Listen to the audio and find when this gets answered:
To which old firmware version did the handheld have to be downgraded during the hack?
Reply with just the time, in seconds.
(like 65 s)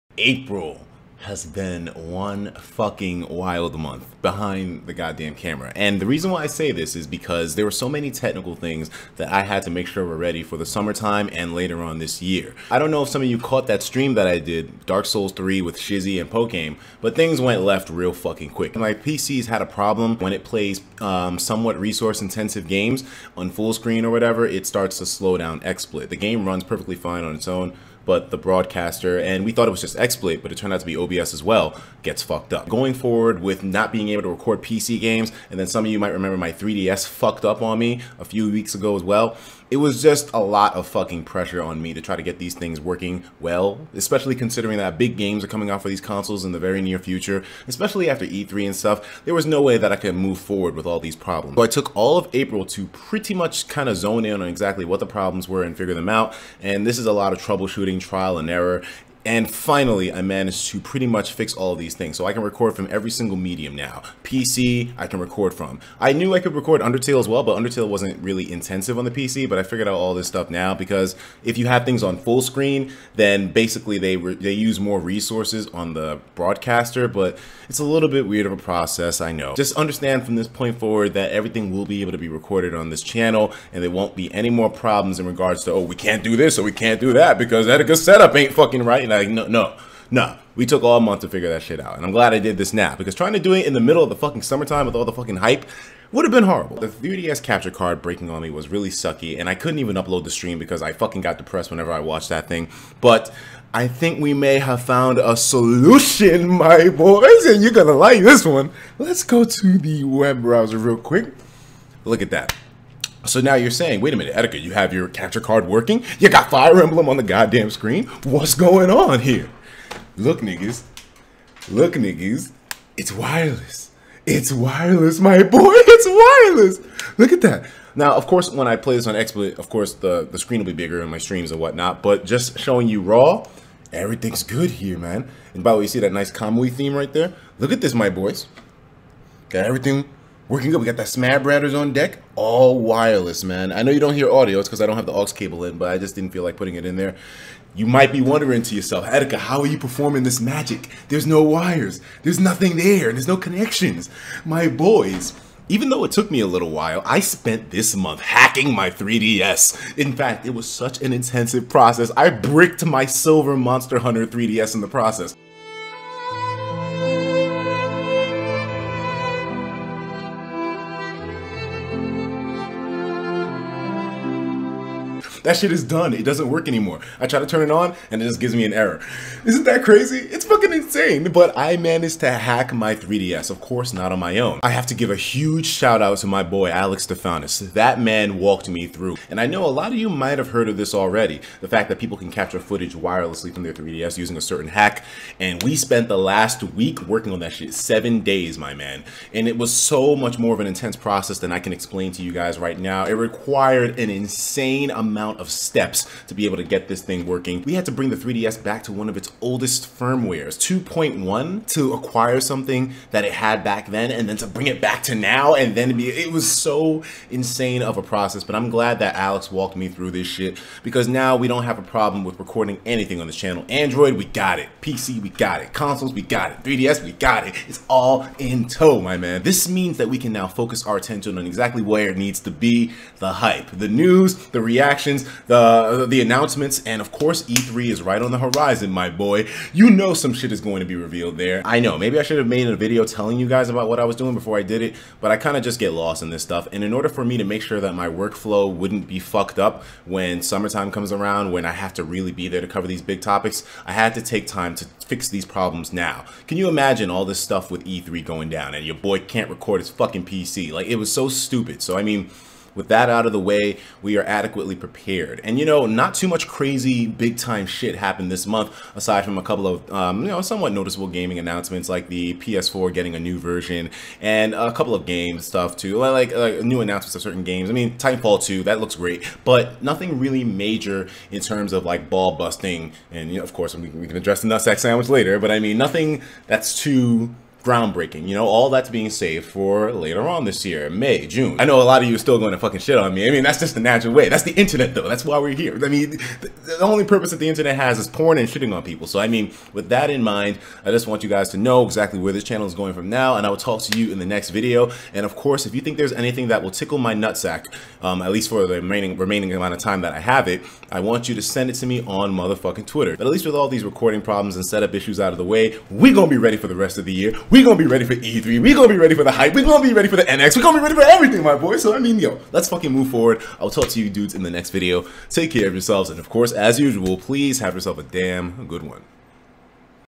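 210 s.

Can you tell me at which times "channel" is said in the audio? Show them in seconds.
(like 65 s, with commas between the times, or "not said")
83 s, 223 s, 302 s.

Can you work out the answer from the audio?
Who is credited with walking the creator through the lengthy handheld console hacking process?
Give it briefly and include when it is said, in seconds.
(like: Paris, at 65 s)
Alex Stefanis, at 186 s.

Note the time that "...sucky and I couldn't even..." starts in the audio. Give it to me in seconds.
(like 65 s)
98 s.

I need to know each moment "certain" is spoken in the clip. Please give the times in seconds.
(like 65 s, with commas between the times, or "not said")
194 s, 277 s.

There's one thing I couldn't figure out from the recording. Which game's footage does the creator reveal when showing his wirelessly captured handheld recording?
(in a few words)
Fire Emblem.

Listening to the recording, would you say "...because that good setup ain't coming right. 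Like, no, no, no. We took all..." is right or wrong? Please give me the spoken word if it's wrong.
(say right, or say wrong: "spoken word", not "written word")
wrong: "fucking", not "coming".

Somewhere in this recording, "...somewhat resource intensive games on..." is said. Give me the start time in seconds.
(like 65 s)
21 s.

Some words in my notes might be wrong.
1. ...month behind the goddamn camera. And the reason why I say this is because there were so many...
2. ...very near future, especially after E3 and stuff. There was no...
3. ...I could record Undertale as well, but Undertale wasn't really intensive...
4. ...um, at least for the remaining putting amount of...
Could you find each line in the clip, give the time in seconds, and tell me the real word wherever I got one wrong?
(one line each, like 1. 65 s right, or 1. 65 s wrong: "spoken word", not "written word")
1. 3 s right
2. 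46 s right
3. 66 s right
4. 308 s wrong: "remaining", not "putting".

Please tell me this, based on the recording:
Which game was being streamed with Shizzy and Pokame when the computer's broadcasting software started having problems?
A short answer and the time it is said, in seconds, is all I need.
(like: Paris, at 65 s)
Dark Souls 3, at 14 s.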